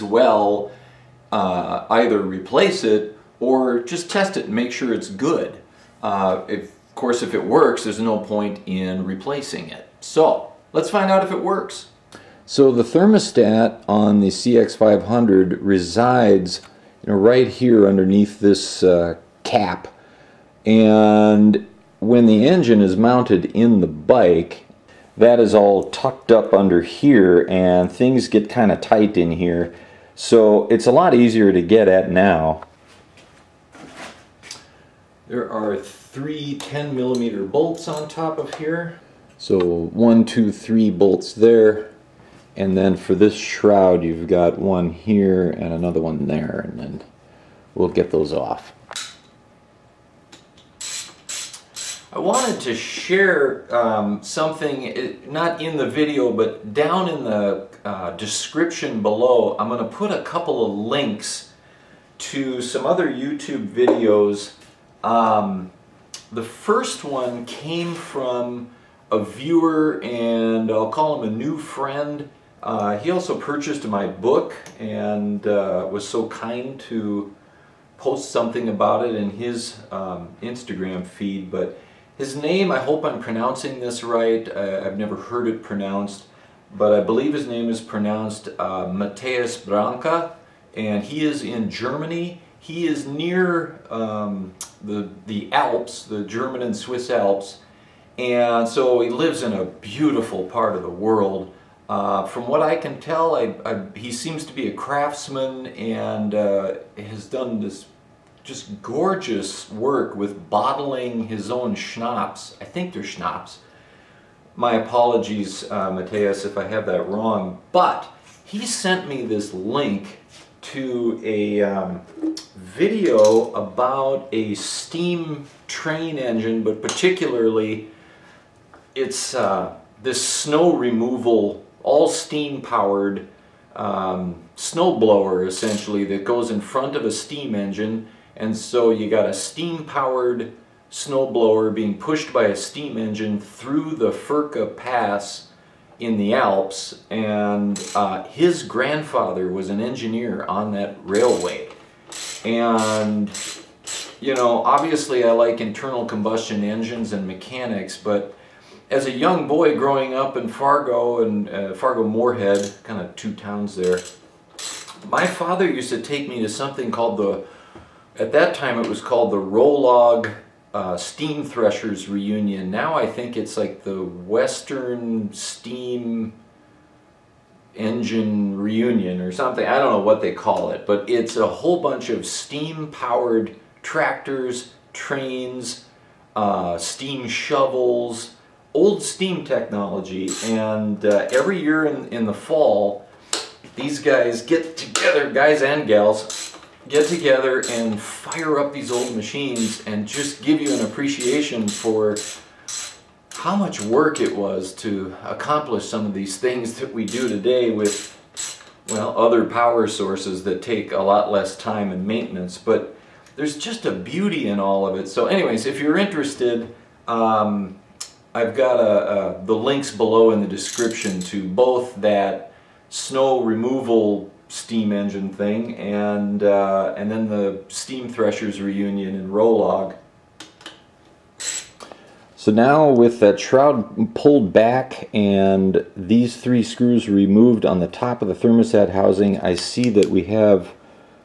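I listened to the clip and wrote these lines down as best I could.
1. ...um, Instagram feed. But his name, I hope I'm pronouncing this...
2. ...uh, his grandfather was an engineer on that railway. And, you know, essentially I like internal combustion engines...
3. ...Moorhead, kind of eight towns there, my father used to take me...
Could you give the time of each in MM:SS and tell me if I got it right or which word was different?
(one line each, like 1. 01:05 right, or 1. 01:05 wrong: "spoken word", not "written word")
1. 01:19 right
2. 02:27 wrong: "obviously", not "essentially"
3. 02:42 wrong: "two", not "eight".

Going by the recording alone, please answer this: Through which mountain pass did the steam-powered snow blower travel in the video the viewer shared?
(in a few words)
Furka Pass.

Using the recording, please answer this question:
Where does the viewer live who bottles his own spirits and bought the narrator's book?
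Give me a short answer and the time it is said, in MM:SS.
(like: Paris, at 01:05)
Germany, at 01:31.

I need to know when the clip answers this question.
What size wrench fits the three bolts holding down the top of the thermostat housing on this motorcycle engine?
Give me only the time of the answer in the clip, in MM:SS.
00:36.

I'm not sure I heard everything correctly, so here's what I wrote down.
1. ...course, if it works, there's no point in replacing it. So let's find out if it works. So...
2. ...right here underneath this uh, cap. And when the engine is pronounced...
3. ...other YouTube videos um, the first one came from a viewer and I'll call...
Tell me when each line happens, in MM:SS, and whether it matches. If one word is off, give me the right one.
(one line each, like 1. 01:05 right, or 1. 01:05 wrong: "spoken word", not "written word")
1. 00:06 right
2. 00:17 wrong: "mounted", not "pronounced"
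3. 01:02 right.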